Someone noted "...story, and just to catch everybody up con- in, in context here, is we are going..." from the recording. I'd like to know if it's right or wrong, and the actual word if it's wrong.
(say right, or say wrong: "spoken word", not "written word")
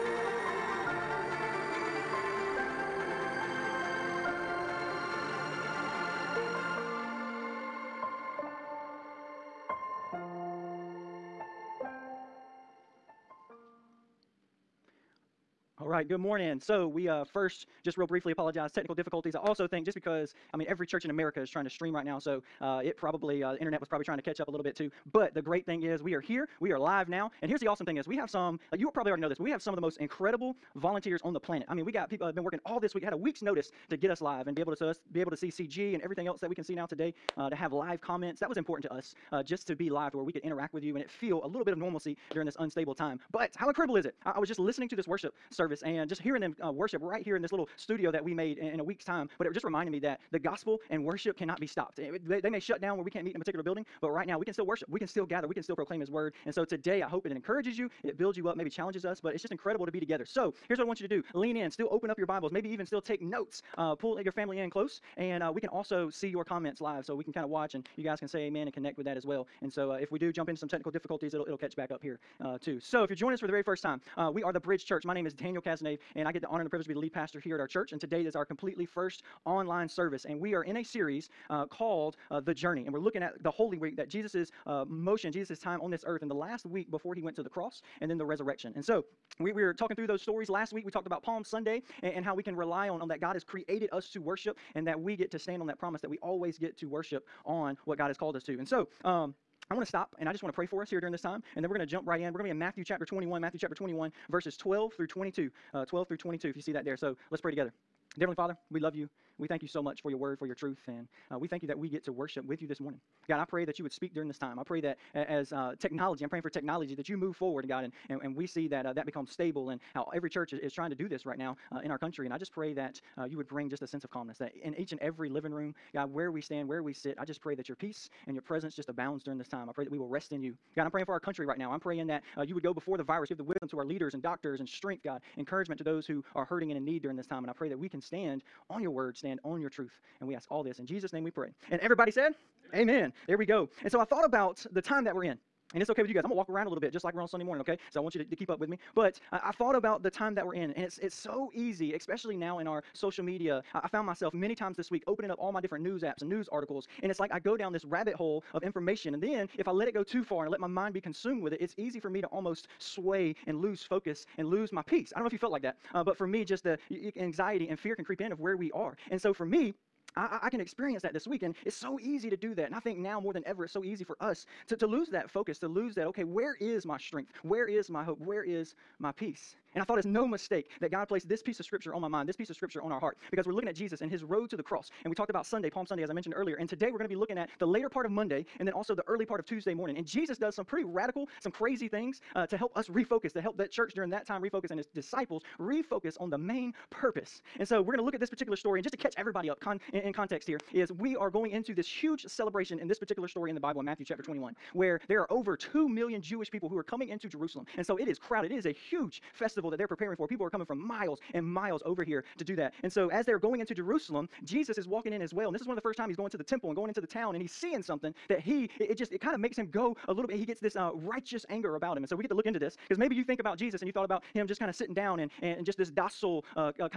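right.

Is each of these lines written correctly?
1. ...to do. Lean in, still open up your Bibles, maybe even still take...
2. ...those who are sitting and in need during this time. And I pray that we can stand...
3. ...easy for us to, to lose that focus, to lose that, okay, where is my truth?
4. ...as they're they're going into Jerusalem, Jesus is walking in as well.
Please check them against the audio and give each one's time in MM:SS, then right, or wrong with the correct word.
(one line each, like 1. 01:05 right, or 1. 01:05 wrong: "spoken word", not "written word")
1. 01:01 right
2. 02:15 wrong: "hurting", not "sitting"
3. 02:53 wrong: "strength", not "truth"
4. 03:33 right.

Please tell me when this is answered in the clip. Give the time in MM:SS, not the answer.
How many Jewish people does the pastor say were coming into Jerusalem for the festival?
03:25.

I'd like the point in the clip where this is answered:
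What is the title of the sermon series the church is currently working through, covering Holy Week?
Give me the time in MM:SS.
01:22.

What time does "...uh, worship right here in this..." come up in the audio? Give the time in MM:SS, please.
00:46.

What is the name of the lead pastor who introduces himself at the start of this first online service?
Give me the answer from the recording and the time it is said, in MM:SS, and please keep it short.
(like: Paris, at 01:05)
Daniel Casanave, at 01:15.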